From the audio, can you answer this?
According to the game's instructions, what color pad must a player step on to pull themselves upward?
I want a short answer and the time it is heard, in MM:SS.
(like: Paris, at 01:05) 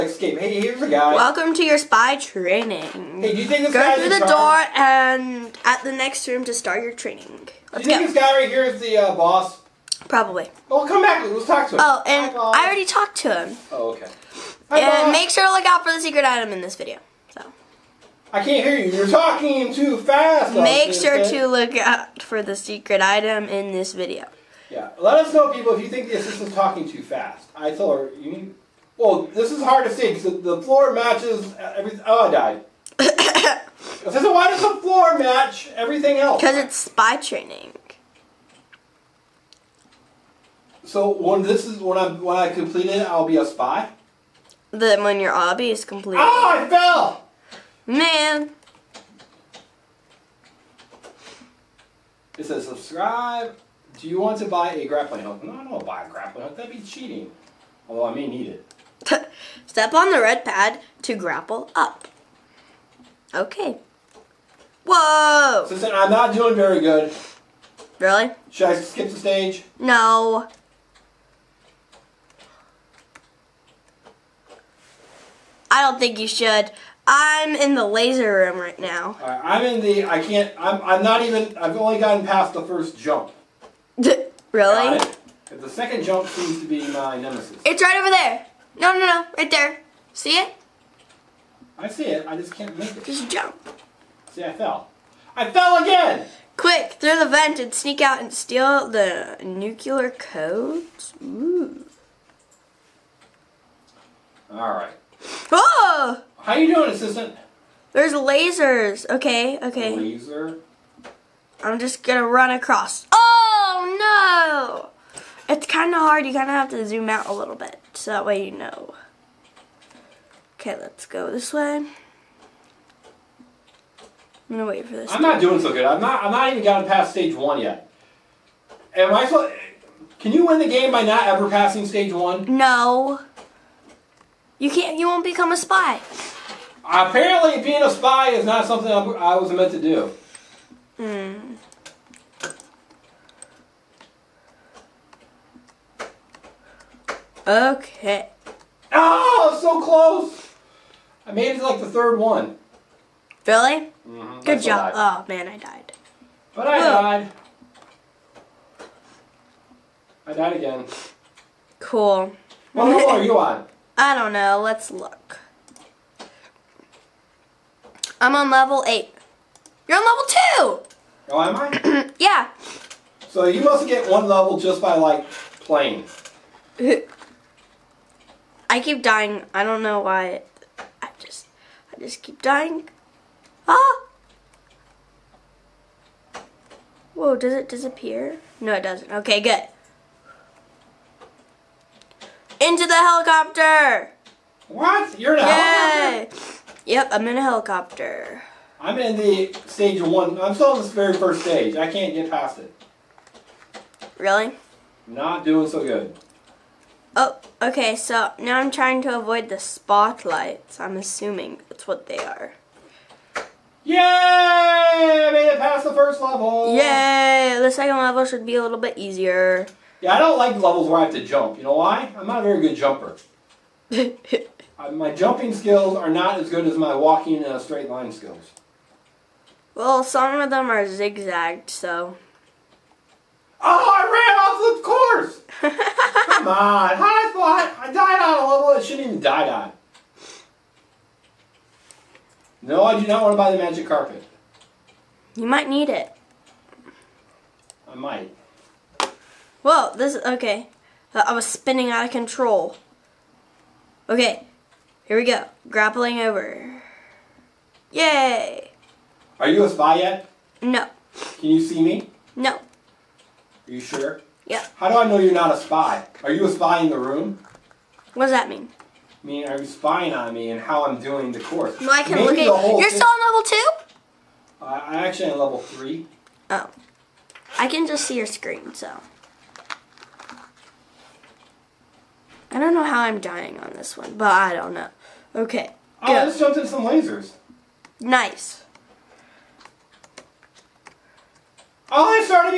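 red, at 01:00.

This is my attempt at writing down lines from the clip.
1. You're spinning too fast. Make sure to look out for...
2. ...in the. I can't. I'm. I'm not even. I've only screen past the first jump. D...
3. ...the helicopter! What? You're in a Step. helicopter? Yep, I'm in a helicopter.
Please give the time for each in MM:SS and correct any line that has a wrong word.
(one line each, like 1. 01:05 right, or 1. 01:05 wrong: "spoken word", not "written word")
1. 00:18 wrong: "talking", not "spinning"
2. 01:19 wrong: "gotten", not "screen"
3. 03:12 wrong: "Yay", not "Step".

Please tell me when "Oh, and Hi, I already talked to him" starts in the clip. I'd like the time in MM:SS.
00:11.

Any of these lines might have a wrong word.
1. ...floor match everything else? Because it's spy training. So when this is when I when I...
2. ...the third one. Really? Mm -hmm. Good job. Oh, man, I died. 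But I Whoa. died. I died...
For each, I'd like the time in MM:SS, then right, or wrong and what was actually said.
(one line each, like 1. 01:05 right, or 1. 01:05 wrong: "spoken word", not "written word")
1. 00:34 right
2. 02:31 right.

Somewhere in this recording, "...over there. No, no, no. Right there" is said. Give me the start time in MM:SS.
01:27.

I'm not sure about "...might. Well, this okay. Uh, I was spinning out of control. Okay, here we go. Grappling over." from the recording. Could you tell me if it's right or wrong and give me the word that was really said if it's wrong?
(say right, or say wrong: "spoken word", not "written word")
right.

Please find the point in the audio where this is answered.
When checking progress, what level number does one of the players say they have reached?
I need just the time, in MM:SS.
02:48.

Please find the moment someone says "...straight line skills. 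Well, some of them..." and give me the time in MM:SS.
03:47.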